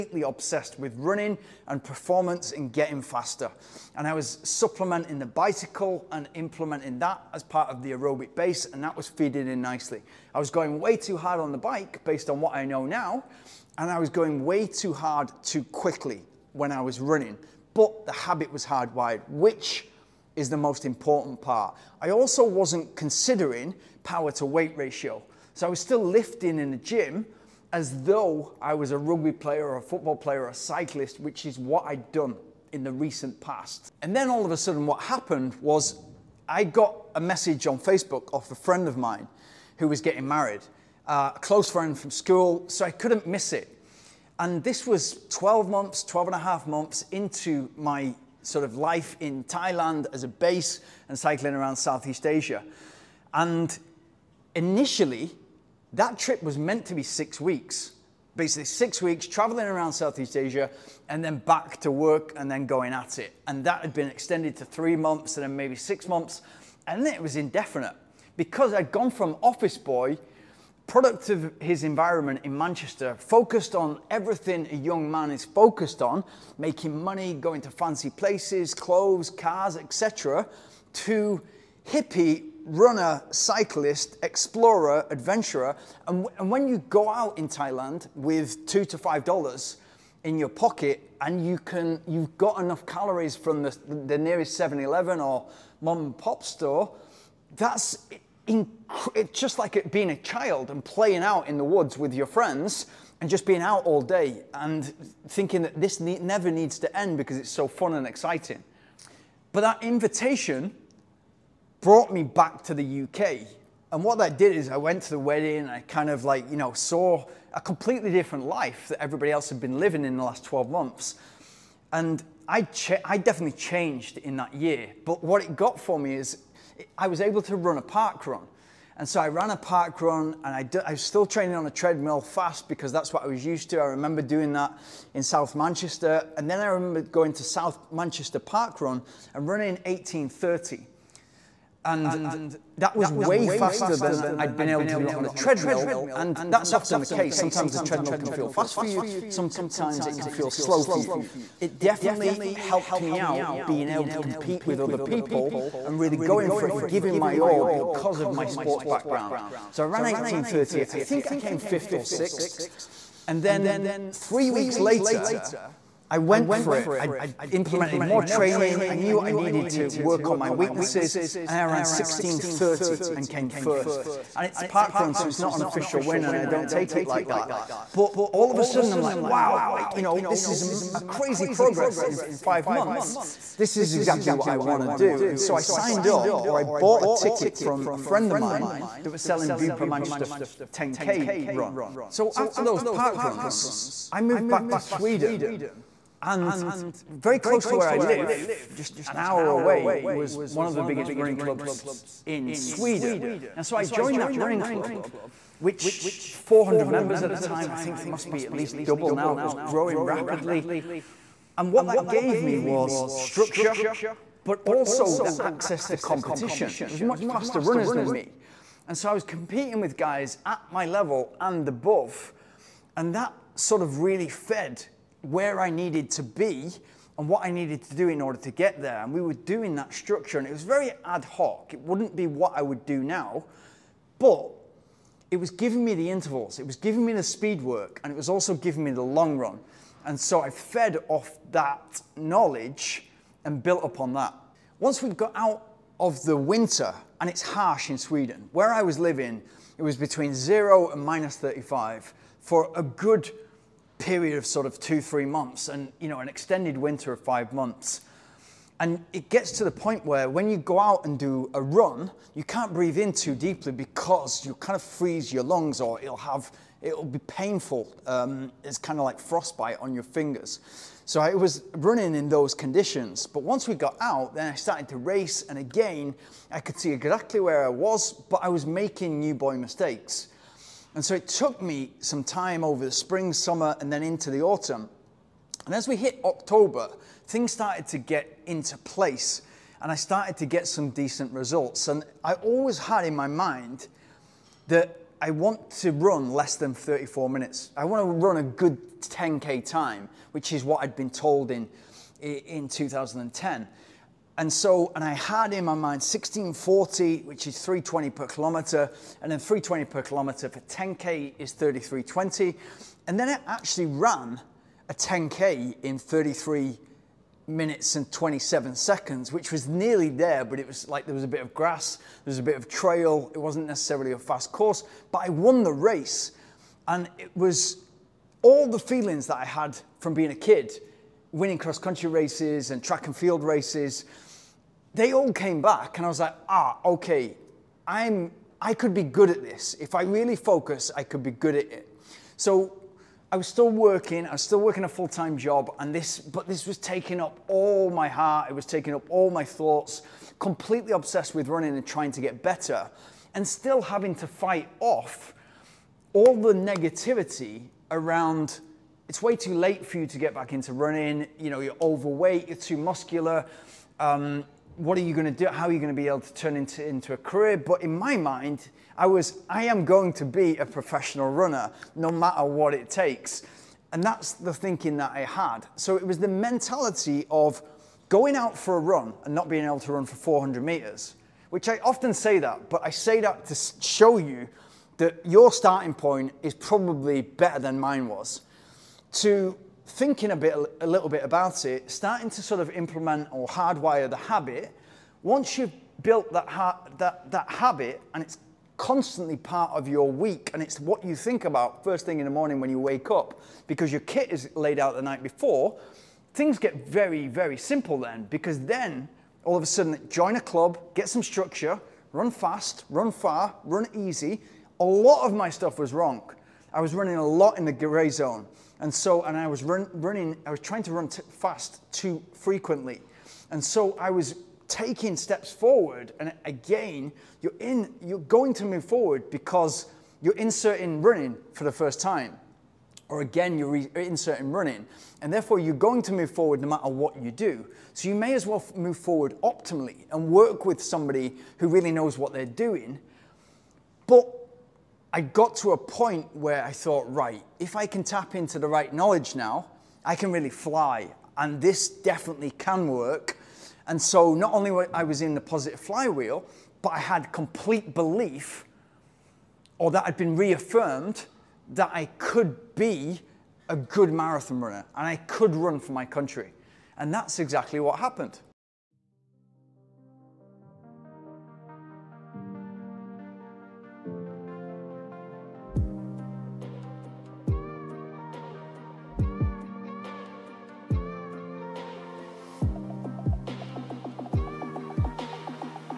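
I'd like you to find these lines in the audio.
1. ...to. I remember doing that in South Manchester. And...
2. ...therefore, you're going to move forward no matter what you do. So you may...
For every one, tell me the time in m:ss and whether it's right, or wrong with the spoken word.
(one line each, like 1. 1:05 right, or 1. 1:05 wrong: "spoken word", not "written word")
1. 2:13 right
2. 7:15 right.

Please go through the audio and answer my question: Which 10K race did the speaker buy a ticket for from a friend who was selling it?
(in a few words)
Bupa Manchester 10K.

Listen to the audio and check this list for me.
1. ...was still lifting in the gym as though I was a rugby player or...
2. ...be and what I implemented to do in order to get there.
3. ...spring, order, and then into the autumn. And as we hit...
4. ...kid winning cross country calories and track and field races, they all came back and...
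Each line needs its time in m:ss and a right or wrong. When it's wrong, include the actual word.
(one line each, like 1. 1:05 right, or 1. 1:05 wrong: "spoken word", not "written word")
1. 0:25 right
2. 3:46 wrong: "needed", not "implemented"
3. 4:42 wrong: "summer", not "order"
4. 5:30 wrong: "races", not "calories".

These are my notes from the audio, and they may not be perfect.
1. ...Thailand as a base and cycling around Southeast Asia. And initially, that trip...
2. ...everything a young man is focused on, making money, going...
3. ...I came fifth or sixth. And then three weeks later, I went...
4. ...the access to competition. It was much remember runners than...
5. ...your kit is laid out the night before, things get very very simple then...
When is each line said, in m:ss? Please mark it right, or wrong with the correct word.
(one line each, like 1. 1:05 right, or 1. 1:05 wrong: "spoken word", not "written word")
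1. 0:49 right
2. 1:14 right
3. 2:41 right
4. 3:35 wrong: "faster", not "remember"
5. 6:43 right.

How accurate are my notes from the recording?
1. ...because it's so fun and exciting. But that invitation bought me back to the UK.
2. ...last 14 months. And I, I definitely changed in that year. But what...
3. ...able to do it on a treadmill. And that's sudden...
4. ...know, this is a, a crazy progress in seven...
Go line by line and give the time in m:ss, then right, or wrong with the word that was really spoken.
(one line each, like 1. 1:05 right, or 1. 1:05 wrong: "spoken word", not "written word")
1. 1:47 wrong: "brought", not "bought"
2. 2:00 wrong: "12", not "14"
3. 2:24 wrong: "often", not "sudden"
4. 3:00 wrong: "five", not "seven".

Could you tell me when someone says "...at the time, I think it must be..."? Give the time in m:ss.
3:27.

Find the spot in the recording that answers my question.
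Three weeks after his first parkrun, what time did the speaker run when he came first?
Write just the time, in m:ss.
2:51.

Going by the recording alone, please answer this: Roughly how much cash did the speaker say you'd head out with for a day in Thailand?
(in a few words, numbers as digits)
$2 to $5.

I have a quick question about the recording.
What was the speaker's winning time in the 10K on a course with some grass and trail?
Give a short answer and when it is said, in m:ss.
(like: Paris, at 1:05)
33:27, at 5:15.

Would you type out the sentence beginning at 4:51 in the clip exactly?
And I always had in my mind that I want to run less than 34 minutes.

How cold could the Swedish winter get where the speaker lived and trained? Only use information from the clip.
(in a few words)
minus 35.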